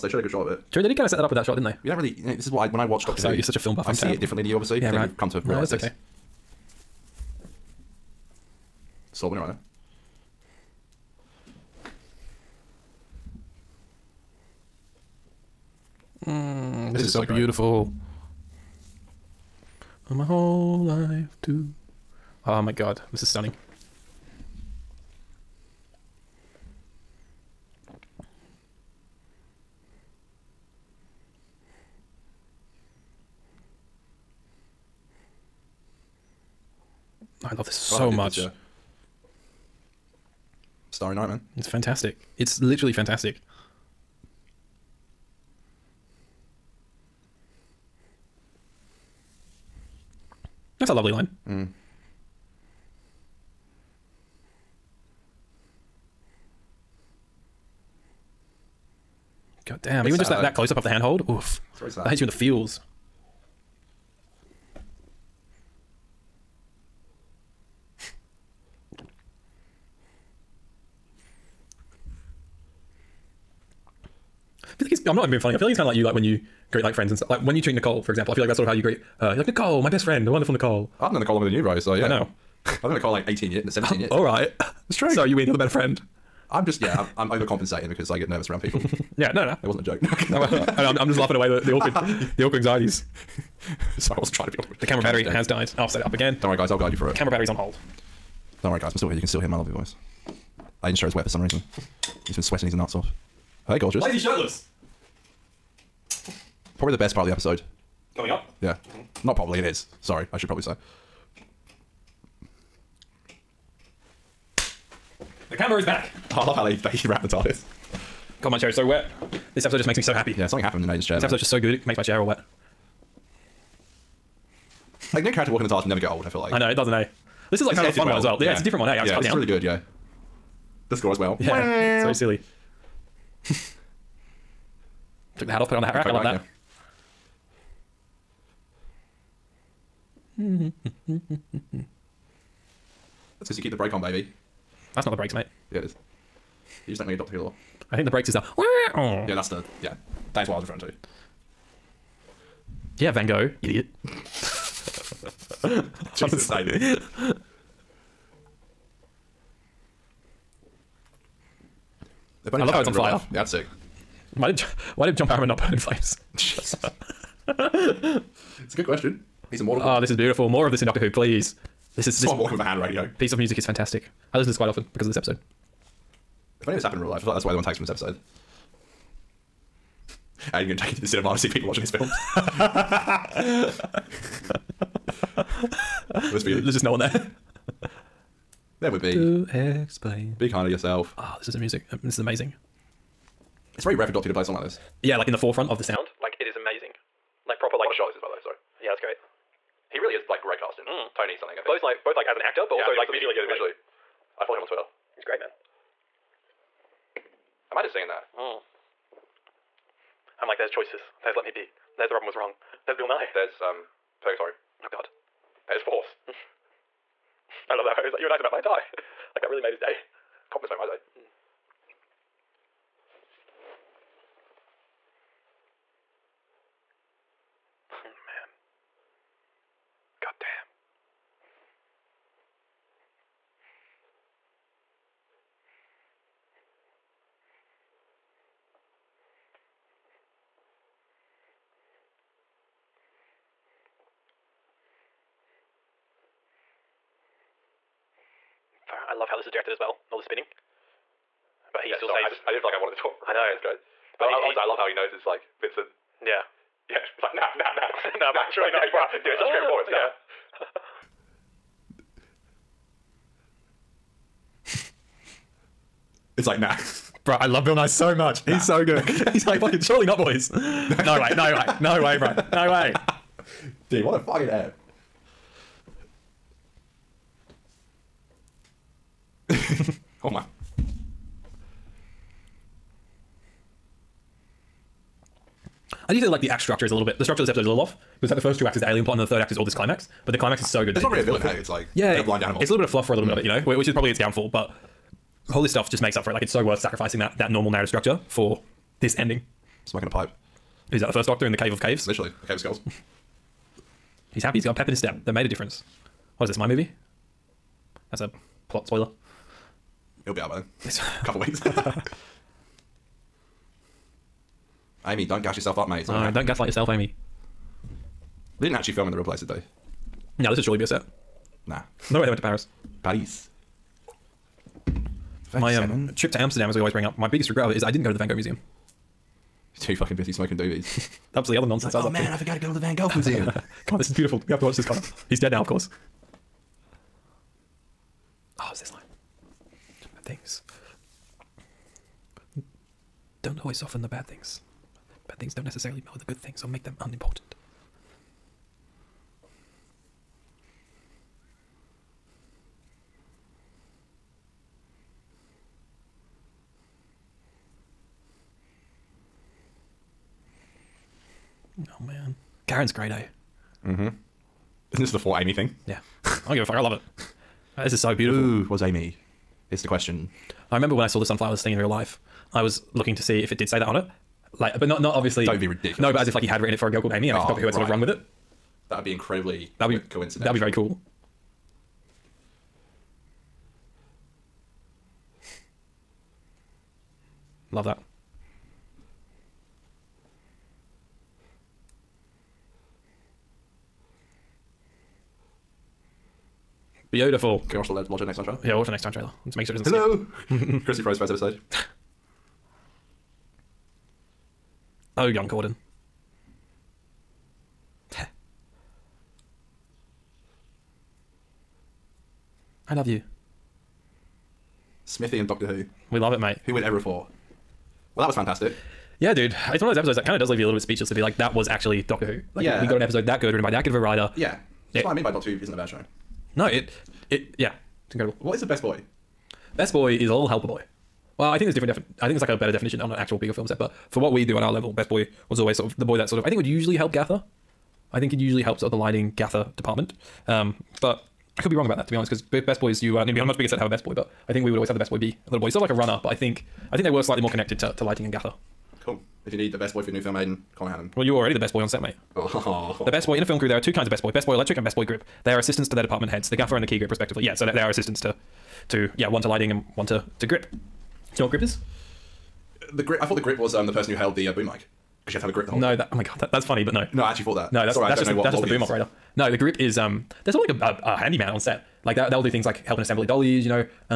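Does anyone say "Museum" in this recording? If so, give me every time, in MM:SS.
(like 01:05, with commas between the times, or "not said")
05:28, 05:33.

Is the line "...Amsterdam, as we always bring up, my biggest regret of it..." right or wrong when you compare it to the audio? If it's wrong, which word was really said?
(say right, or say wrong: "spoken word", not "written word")
right.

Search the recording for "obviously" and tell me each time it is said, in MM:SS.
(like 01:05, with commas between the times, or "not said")
00:04, 06:15.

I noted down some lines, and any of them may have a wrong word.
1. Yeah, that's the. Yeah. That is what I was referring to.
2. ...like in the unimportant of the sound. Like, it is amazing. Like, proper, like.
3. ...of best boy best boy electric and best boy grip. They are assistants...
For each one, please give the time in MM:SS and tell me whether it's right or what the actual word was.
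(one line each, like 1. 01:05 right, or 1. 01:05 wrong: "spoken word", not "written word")
1. 02:29 right
2. 03:15 wrong: "forefront", not "unimportant"
3. 07:34 right.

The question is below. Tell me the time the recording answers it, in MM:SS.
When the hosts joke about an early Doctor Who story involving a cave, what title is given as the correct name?
05:02.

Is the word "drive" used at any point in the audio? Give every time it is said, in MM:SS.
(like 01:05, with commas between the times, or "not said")
not said.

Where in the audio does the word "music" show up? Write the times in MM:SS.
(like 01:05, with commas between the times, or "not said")
02:53, 03:11.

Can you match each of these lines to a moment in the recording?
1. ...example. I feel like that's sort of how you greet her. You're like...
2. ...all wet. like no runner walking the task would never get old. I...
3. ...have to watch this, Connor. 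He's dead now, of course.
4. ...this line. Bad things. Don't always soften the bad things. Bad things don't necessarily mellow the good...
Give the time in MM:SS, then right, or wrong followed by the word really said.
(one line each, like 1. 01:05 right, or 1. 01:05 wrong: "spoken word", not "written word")
1. 01:18 right
2. 02:02 wrong: "character", not "runner"
3. 05:34 right
4. 05:38 right.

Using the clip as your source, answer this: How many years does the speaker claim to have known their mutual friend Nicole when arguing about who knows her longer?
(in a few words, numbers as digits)
18.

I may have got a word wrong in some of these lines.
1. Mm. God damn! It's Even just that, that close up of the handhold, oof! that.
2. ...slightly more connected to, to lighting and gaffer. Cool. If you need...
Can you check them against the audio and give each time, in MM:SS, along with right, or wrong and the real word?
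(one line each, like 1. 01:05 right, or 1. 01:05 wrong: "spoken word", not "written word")
1. 00:51 right
2. 07:27 right.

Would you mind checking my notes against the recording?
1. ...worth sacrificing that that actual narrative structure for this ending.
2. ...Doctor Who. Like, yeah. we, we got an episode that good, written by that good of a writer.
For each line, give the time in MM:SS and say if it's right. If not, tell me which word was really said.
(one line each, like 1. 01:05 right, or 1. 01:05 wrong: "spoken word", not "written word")
1. 04:56 wrong: "normal", not "actual"
2. 07:02 right.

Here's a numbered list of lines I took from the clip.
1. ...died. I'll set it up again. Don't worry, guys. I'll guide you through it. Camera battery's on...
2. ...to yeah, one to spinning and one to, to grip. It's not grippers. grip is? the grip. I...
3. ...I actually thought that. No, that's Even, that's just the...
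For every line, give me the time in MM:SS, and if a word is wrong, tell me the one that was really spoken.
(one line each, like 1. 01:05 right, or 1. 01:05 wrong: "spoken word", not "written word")
1. 01:35 right
2. 07:38 wrong: "lighting", not "spinning"
3. 07:47 wrong: "Sorry", not "Even".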